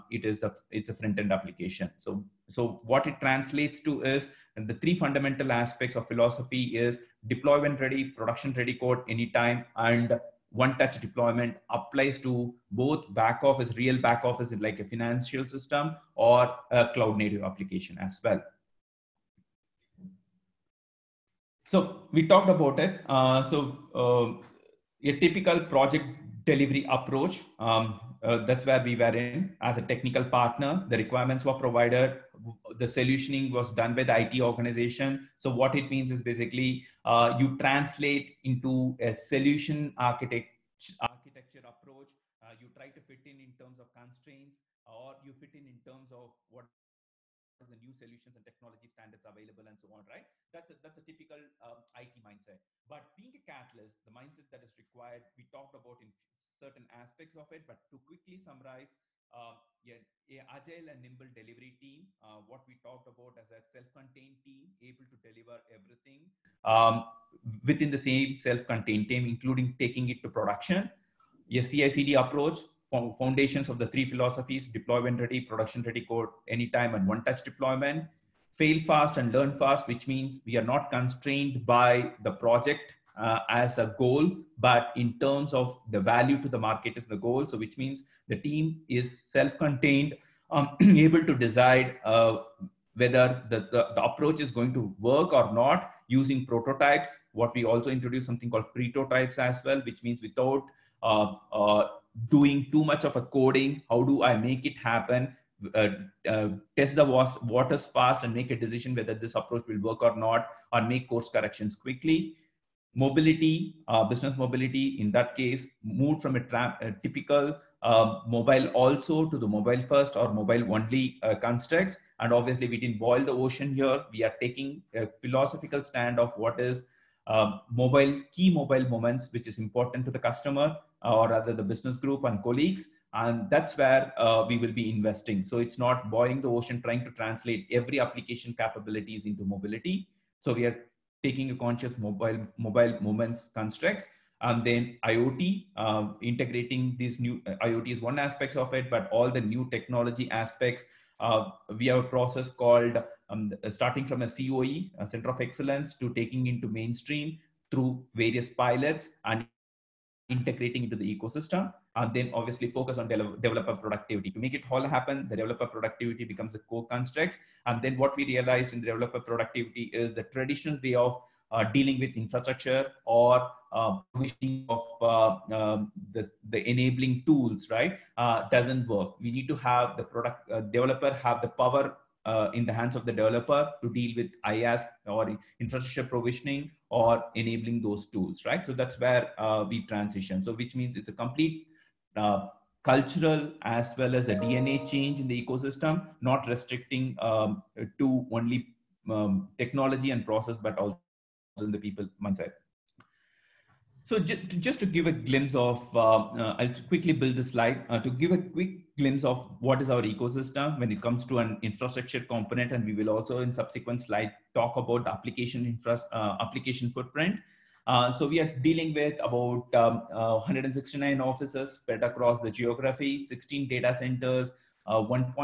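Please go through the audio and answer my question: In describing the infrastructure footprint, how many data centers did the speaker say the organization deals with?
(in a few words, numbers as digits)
16.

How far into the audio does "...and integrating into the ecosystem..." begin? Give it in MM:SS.
02:39.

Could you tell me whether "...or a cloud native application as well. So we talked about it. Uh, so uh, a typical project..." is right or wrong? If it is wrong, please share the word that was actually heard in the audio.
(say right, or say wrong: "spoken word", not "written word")
right.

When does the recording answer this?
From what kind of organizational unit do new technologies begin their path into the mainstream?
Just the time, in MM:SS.
02:35.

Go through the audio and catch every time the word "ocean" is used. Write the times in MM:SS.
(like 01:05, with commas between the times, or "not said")
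02:03, 02:16.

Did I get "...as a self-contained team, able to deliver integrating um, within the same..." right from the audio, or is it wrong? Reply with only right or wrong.
wrong.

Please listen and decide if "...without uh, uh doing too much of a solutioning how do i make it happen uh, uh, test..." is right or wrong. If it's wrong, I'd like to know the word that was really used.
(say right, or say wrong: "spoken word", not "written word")
wrong: "coding", not "solutioning".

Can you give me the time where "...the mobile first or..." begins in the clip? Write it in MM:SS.
01:59.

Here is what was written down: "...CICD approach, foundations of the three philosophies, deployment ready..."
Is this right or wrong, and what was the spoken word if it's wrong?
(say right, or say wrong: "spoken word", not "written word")
right.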